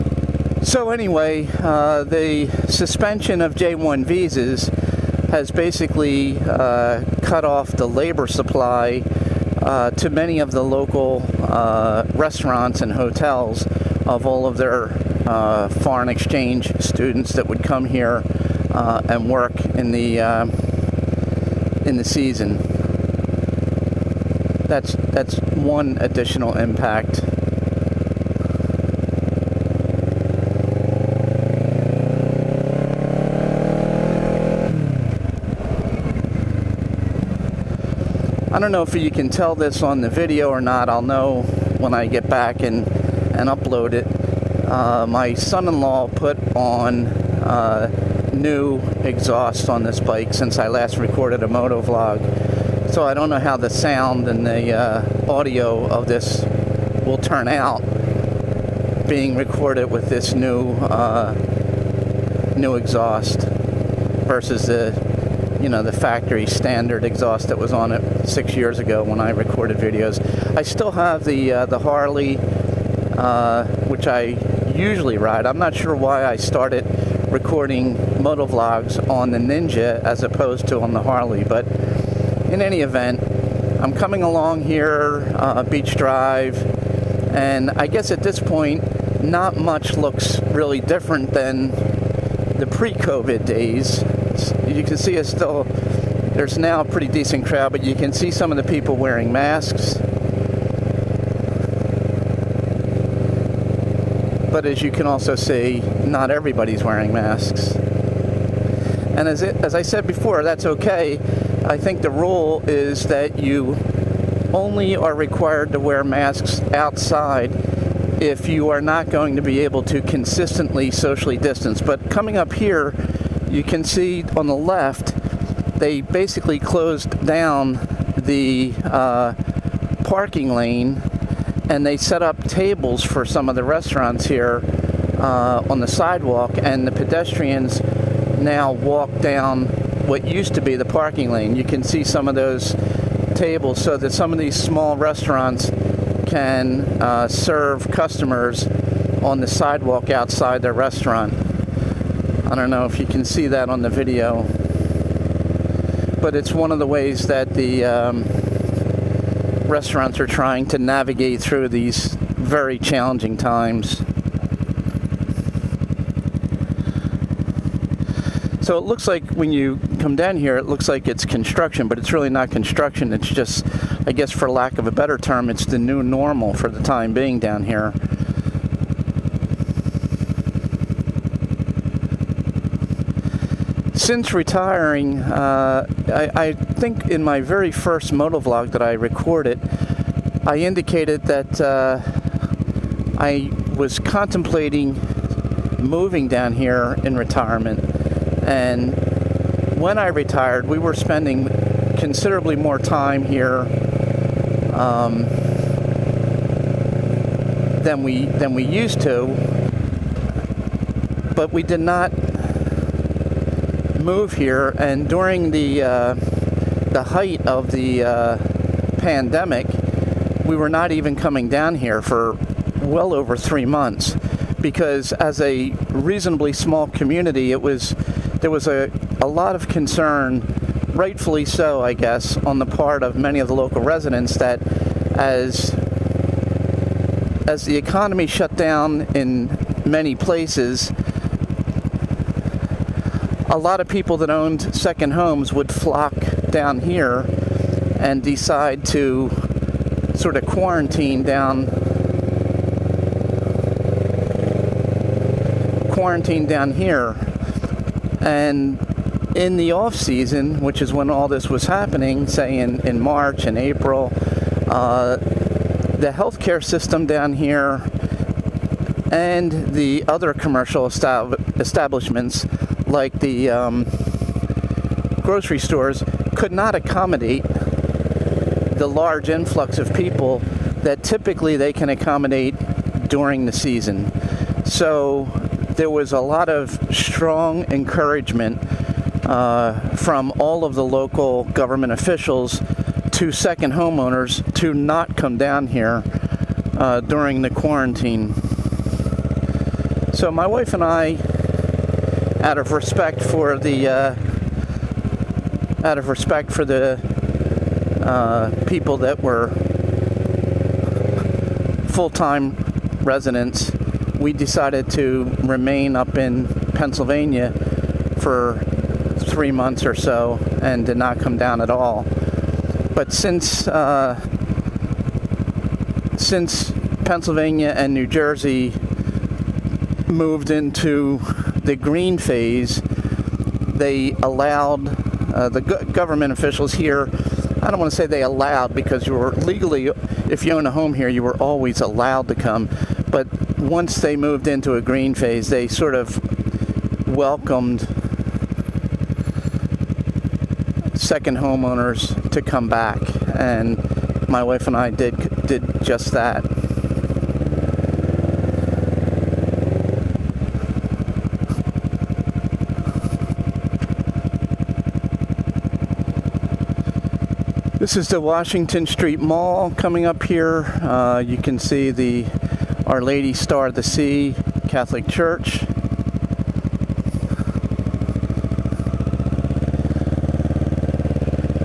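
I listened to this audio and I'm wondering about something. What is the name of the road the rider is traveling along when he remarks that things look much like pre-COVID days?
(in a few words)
Beach Drive.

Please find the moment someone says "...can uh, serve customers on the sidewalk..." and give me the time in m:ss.
2:26.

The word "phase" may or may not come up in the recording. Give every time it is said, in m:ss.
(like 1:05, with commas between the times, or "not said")
5:32, 5:45.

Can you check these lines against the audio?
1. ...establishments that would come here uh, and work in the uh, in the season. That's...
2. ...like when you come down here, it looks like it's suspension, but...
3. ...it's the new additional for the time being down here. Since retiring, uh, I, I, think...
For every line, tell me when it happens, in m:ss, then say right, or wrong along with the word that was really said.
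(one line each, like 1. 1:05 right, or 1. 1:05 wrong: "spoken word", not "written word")
1. 0:16 wrong: "students", not "establishments"
2. 2:49 wrong: "construction", not "suspension"
3. 2:55 wrong: "normal", not "additional".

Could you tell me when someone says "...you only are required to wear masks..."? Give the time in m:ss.
1:53.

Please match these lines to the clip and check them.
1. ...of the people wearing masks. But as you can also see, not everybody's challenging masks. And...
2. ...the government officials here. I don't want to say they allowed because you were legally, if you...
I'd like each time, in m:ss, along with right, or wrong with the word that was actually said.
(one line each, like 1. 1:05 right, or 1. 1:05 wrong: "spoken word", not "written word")
1. 1:38 wrong: "wearing", not "challenging"
2. 5:35 right.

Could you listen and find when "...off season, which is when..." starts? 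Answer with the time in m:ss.
4:19.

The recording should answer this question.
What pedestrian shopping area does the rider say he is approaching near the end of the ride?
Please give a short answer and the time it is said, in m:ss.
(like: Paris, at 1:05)
Washington Street Mall, at 6:08.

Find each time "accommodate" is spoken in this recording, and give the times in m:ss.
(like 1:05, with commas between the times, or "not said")
4:36, 4:41.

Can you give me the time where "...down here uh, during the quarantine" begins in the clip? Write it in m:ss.
4:55.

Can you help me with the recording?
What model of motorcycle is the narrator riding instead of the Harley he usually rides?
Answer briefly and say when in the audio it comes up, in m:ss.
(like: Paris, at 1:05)
Ninja, at 1:19.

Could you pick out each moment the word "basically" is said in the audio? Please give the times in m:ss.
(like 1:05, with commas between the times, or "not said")
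0:05, 2:06.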